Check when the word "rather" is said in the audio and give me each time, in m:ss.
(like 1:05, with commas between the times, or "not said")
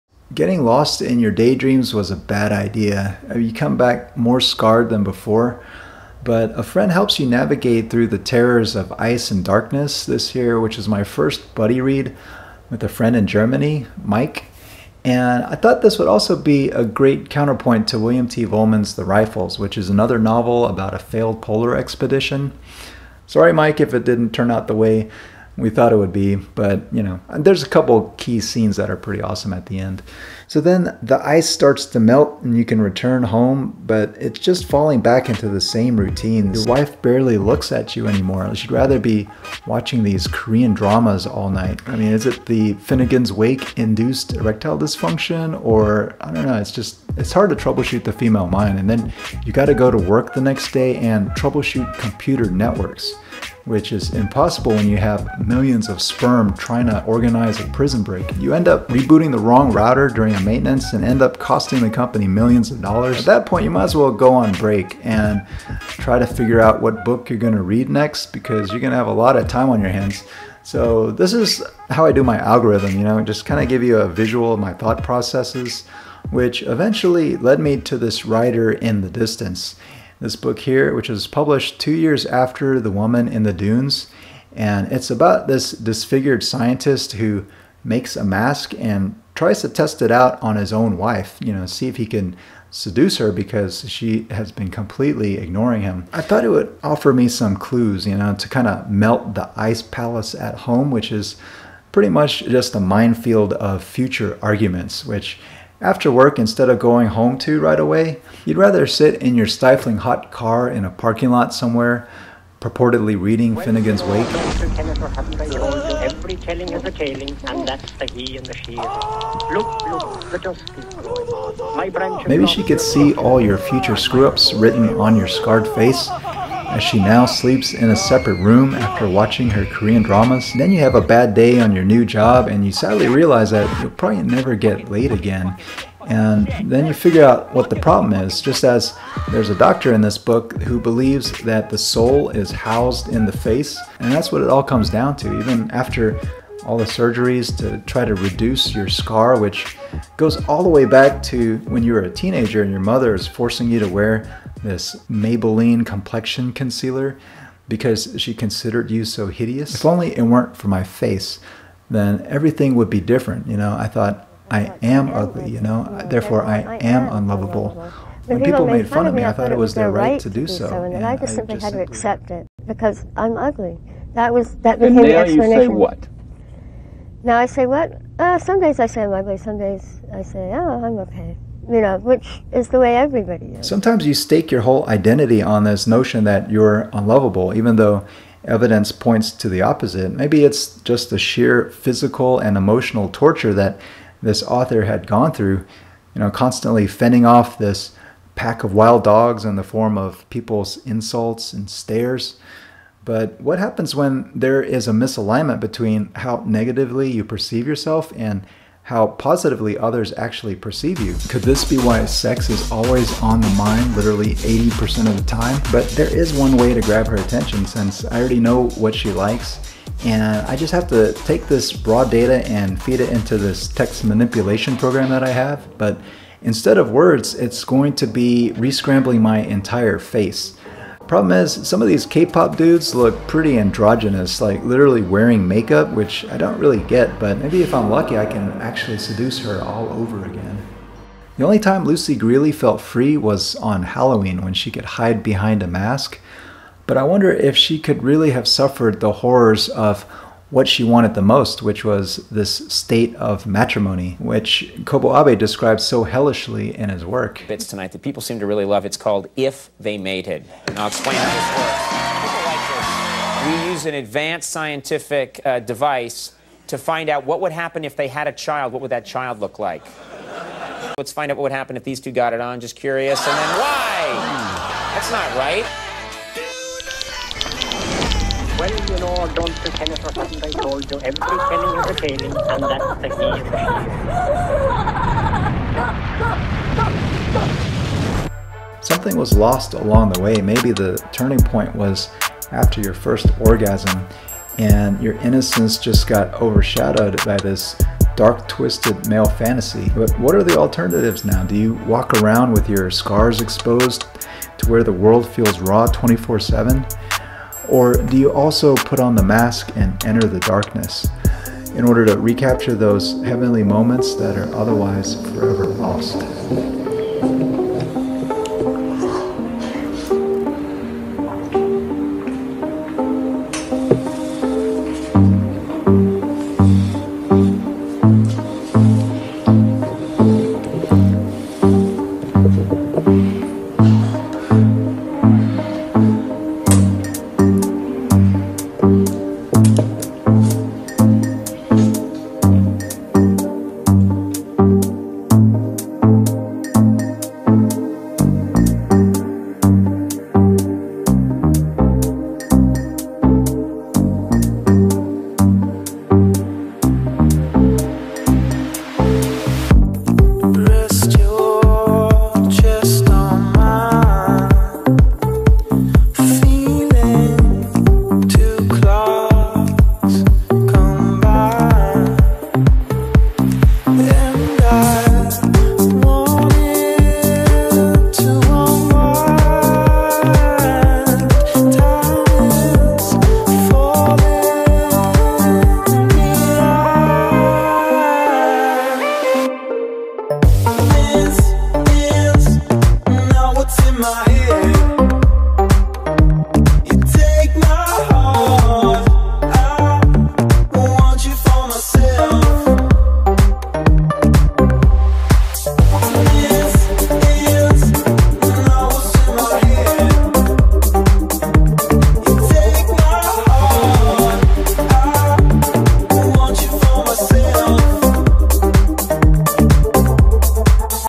0:38, 1:48.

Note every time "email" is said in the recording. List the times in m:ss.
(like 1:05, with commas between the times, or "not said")
not said.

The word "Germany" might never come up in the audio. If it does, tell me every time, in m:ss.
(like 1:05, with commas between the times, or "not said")
0:13.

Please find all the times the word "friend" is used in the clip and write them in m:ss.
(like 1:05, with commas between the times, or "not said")
0:06, 0:12.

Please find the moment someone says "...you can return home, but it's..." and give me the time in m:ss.
0:32.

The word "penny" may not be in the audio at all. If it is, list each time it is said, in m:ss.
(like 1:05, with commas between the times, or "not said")
4:41.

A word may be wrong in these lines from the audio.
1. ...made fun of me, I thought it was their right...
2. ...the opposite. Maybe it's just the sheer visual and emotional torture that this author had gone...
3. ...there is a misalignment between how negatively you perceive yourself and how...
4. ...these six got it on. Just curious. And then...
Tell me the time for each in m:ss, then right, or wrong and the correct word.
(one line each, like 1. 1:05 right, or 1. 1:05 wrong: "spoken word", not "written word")
1. 2:48 right
2. 3:09 wrong: "physical", not "visual"
3. 3:24 right
4. 4:31 wrong: "two", not "six".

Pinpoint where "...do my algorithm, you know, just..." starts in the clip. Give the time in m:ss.
1:12.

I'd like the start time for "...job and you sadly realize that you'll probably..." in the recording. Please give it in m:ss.
2:12.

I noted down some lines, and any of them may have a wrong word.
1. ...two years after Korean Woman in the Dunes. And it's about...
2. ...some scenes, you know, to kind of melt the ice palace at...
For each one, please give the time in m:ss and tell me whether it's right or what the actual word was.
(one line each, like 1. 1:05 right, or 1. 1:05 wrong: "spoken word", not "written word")
1. 1:21 wrong: "The", not "Korean"
2. 1:37 wrong: "clues", not "scenes".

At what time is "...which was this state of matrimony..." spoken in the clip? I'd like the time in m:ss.
4:11.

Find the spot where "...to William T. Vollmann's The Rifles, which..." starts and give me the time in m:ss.
0:17.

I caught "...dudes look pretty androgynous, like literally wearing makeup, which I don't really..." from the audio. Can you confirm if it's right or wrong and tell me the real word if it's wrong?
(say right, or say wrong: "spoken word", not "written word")
right.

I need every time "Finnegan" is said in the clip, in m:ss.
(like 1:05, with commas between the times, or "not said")
0:42, 1:53.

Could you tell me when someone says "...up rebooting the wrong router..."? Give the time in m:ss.
0:58.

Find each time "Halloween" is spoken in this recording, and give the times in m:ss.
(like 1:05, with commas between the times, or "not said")
4:03.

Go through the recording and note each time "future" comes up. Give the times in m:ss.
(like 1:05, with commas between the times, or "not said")
1:43, 2:03.